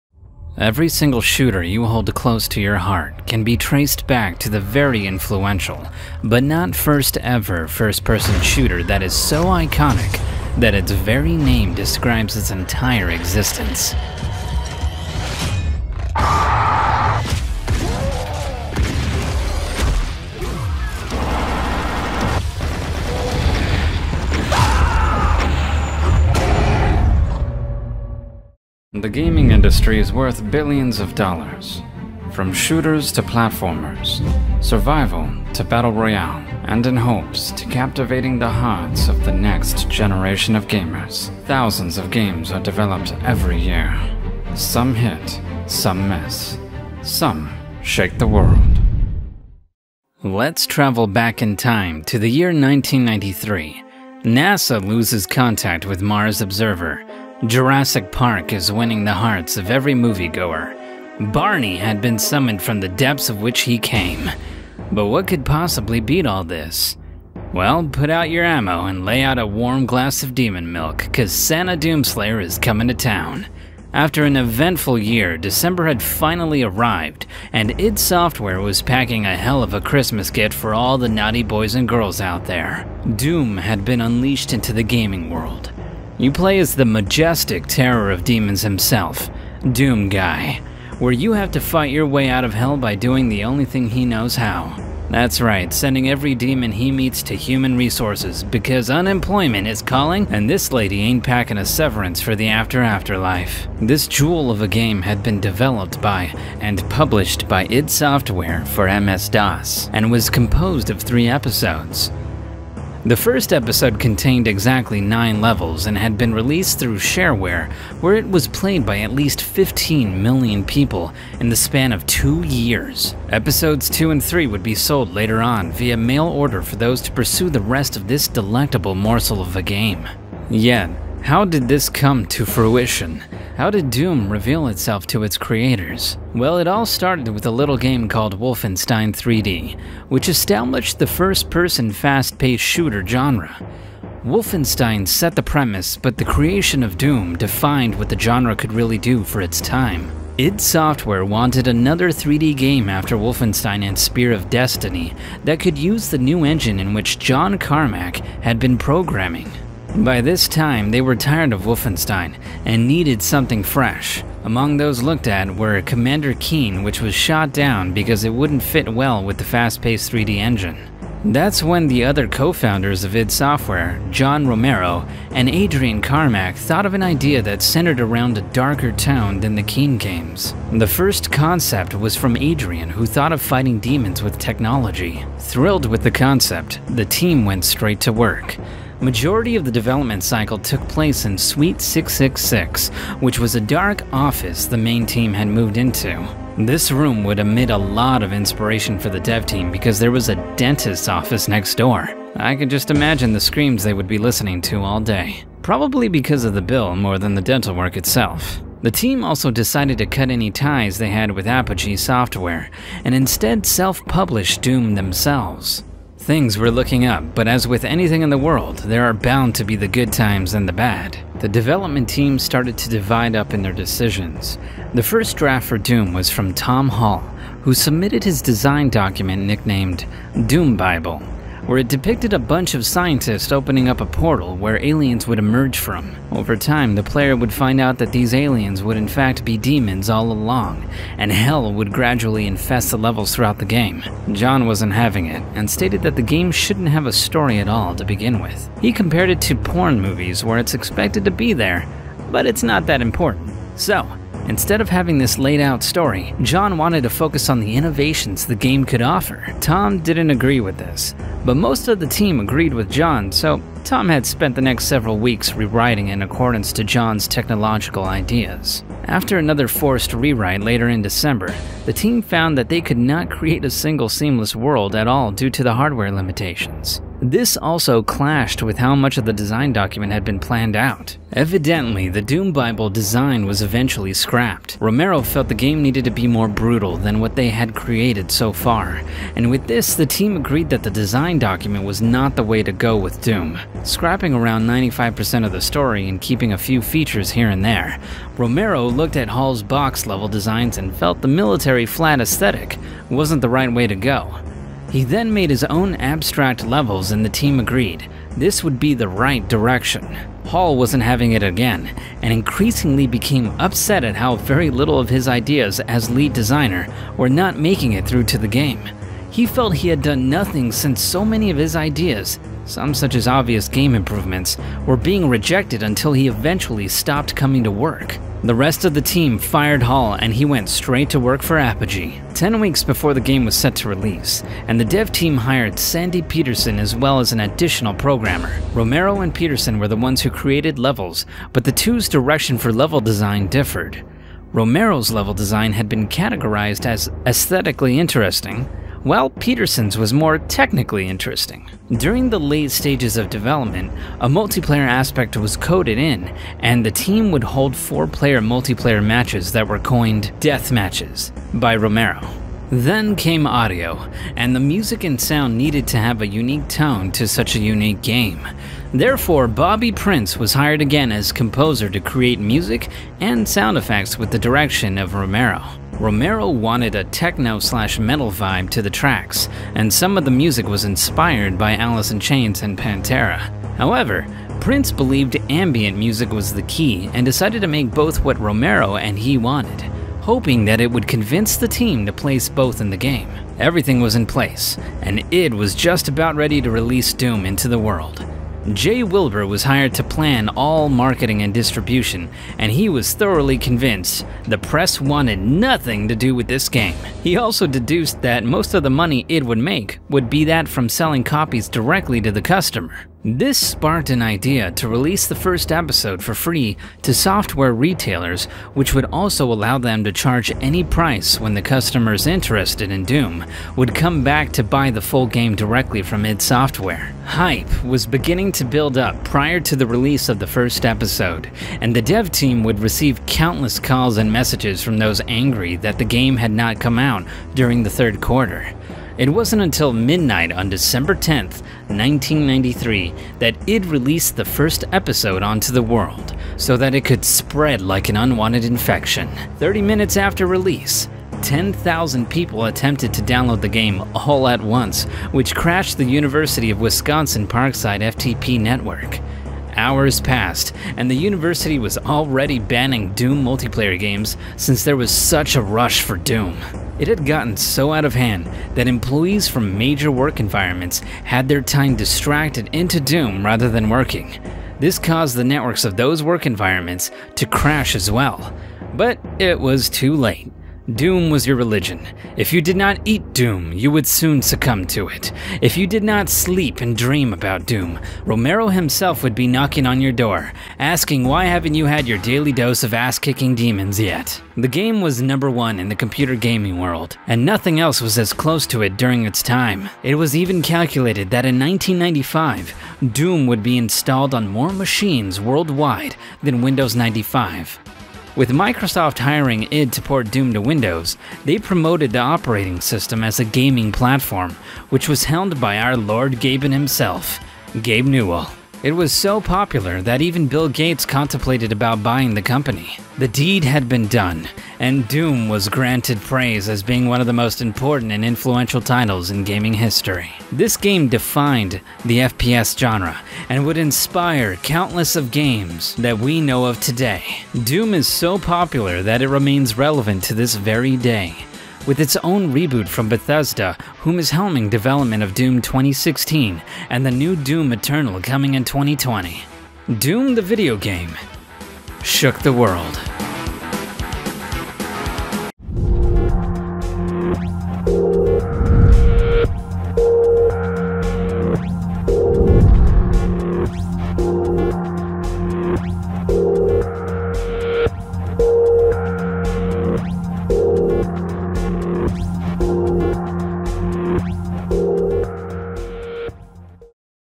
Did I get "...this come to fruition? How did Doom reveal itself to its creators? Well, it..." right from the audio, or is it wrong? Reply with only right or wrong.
right.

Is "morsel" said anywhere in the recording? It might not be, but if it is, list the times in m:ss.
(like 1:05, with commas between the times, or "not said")
2:08.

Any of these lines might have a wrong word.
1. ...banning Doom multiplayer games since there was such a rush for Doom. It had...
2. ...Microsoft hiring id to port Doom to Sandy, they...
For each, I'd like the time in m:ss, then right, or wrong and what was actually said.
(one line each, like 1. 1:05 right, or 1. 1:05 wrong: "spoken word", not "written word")
1. 7:42 right
2. 8:28 wrong: "Windows", not "Sandy".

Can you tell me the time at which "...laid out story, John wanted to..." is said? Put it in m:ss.
4:15.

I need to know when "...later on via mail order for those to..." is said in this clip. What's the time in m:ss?
2:05.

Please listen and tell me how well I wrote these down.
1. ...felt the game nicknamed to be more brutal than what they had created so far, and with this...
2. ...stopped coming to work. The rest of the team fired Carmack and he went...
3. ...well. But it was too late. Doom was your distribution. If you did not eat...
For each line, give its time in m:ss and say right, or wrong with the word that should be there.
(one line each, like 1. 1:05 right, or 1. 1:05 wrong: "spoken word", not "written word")
1. 4:45 wrong: "needed", not "nicknamed"
2. 5:26 wrong: "Hall", not "Carmack"
3. 7:58 wrong: "religion", not "distribution".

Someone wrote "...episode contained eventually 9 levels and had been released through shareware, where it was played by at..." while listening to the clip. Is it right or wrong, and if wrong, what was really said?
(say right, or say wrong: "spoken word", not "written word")
wrong: "exactly", not "eventually".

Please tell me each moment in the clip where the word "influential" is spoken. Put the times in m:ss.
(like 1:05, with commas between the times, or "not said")
0:05, 8:48.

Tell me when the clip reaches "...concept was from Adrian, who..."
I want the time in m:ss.
3:01.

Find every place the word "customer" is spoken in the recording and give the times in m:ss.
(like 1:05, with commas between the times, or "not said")
6:52, 7:01.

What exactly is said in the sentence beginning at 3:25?
Probably because of the bill more than the dental work itself.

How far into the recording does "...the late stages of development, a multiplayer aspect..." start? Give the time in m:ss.
5:52.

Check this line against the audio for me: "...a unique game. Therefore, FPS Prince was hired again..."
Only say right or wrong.
wrong.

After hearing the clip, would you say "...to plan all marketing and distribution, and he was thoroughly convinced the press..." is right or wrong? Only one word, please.
right.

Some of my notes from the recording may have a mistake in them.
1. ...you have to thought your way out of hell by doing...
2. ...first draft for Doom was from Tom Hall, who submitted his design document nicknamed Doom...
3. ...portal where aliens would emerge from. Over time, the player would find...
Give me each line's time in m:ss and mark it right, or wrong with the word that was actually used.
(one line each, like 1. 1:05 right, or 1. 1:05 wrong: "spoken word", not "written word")
1. 1:31 wrong: "fight", not "thought"
2. 3:45 right
3. 3:54 right.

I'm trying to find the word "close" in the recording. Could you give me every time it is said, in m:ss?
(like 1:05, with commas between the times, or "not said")
0:02, 8:18.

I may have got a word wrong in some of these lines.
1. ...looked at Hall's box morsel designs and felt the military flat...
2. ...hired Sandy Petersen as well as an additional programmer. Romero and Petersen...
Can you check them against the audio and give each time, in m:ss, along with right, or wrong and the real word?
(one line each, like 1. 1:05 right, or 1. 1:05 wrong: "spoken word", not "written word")
1. 4:58 wrong: "level", not "morsel"
2. 5:35 right.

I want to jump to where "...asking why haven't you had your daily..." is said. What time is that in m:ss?
8:10.